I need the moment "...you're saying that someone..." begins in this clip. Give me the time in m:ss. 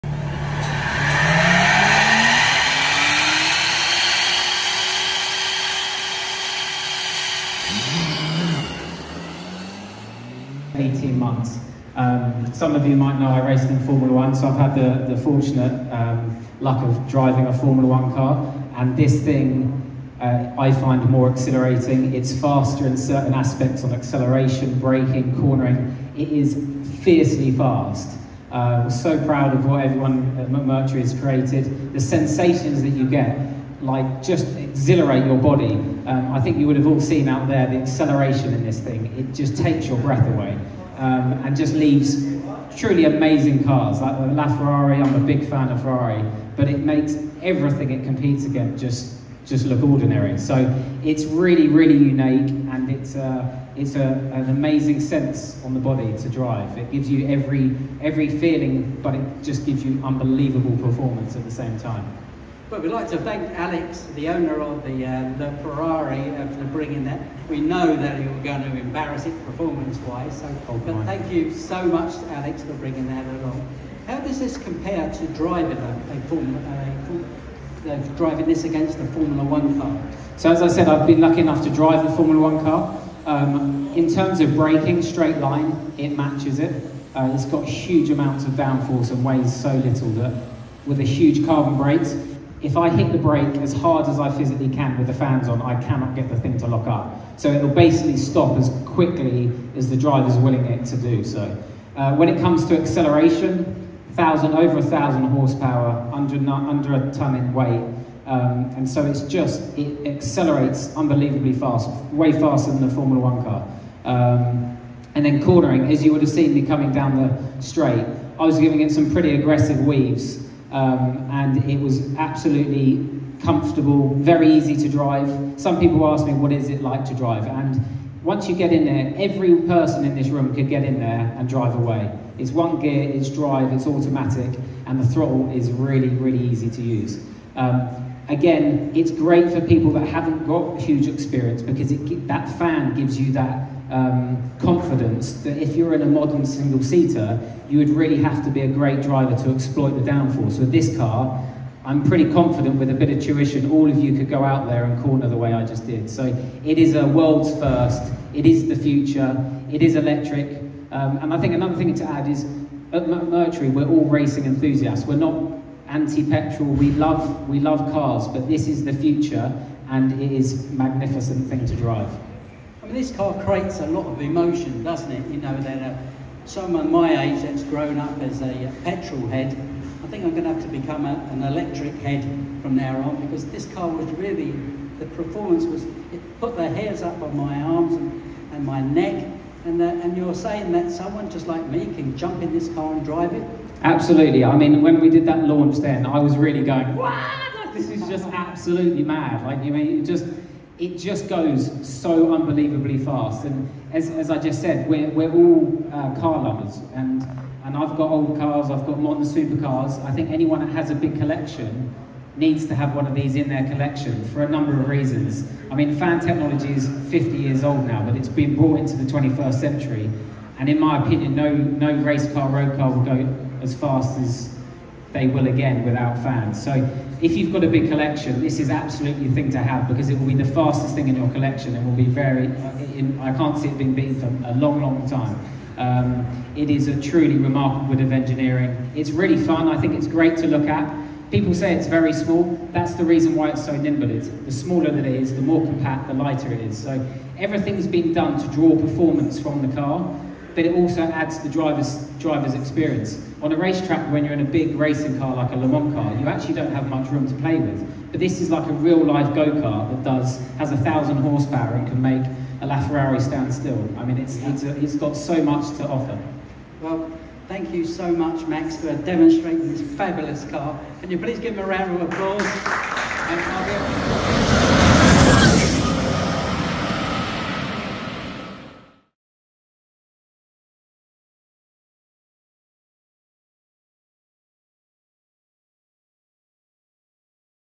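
3:10.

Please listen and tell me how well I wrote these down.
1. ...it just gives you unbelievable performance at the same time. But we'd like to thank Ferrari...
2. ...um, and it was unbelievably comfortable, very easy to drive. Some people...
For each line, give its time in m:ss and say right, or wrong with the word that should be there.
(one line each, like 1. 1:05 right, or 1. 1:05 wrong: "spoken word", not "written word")
1. 0:59 wrong: "Alex", not "Ferrari"
2. 2:00 wrong: "absolutely", not "unbelievably".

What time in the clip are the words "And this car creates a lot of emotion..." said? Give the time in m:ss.
2:52.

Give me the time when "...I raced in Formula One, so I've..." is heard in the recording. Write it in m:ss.
0:13.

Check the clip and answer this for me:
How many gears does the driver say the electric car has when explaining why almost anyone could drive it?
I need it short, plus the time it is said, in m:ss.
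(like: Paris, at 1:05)
1, at 2:12.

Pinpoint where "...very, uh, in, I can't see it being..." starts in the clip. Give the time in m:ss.
3:52.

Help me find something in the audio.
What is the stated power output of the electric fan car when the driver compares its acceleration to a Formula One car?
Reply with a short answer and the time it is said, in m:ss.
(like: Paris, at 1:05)
over 1,000 horsepower, at 1:44.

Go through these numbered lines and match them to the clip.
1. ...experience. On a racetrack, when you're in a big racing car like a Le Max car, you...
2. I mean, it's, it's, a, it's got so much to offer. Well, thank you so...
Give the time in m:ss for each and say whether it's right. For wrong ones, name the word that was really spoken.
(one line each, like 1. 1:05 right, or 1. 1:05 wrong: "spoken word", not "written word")
1. 4:12 wrong: "Mans", not "Max"
2. 4:23 right.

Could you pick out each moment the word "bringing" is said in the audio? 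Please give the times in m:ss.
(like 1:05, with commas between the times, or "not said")
1:06, 1:12.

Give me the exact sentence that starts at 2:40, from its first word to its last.
Um, and I think another thing to add is at McMurtry, we're all racing enthusiasts.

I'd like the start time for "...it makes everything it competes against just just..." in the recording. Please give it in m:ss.
0:46.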